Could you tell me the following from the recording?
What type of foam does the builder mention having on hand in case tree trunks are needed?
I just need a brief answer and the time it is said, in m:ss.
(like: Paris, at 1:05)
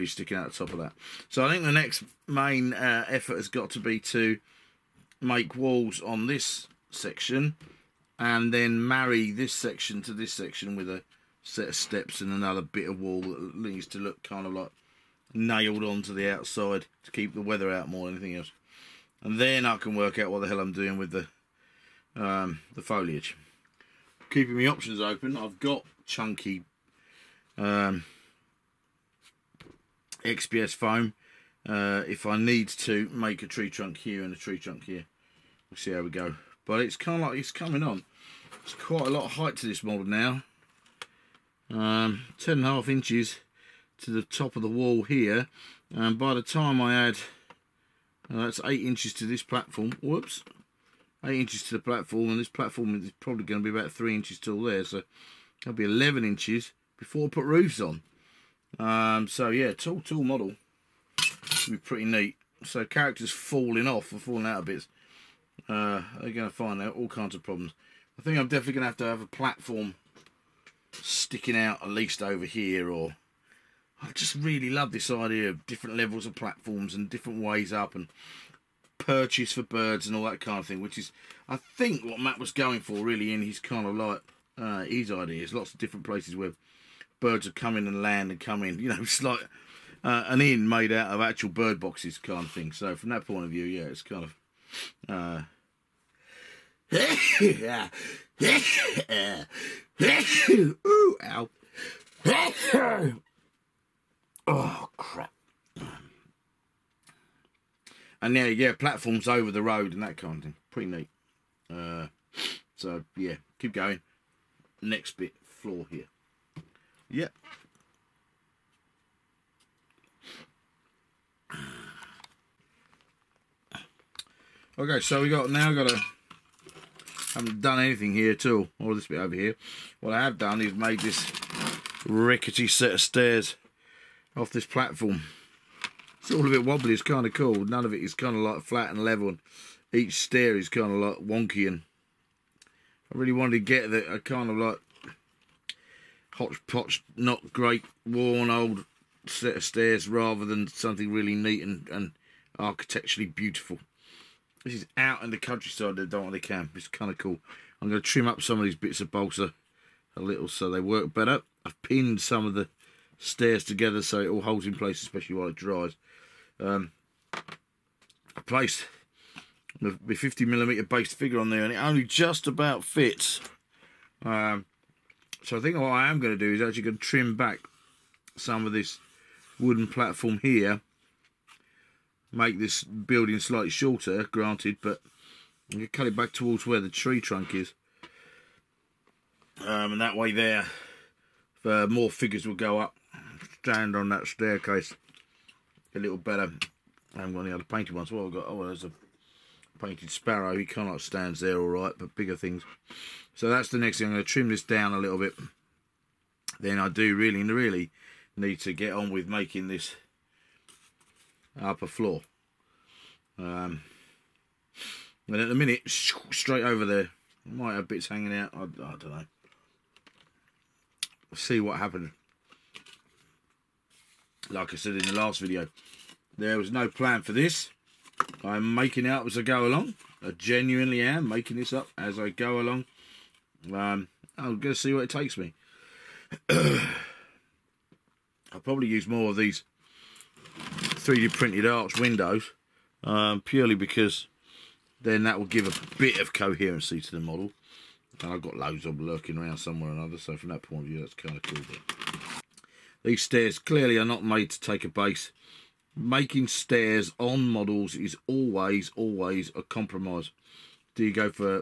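XPS foam, at 0:30.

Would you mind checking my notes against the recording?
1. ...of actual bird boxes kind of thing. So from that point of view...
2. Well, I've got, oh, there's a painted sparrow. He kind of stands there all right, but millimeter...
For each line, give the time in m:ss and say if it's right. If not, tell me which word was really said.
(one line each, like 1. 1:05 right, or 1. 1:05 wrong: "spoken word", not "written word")
1. 1:31 right
2. 3:18 wrong: "bigger", not "millimeter".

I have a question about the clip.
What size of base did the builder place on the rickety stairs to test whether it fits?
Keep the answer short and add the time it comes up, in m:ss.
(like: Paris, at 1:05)
50 millimeter, at 2:50.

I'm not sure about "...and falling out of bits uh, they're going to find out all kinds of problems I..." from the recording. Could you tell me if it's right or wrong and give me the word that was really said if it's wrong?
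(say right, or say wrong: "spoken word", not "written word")
right.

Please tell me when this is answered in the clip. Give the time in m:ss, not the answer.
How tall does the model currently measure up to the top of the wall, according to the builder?
0:42.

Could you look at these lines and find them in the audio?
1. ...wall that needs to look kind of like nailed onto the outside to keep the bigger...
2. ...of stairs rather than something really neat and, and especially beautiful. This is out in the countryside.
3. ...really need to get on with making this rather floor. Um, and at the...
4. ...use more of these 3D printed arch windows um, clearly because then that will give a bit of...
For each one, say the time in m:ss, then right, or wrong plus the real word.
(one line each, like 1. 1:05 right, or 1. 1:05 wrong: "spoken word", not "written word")
1. 0:12 wrong: "weather", not "bigger"
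2. 2:29 wrong: "architecturally", not "especially"
3. 3:27 wrong: "upper", not "rather"
4. 3:58 wrong: "purely", not "clearly".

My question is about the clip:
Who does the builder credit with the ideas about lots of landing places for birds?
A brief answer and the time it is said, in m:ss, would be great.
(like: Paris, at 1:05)
Matt, at 1:22.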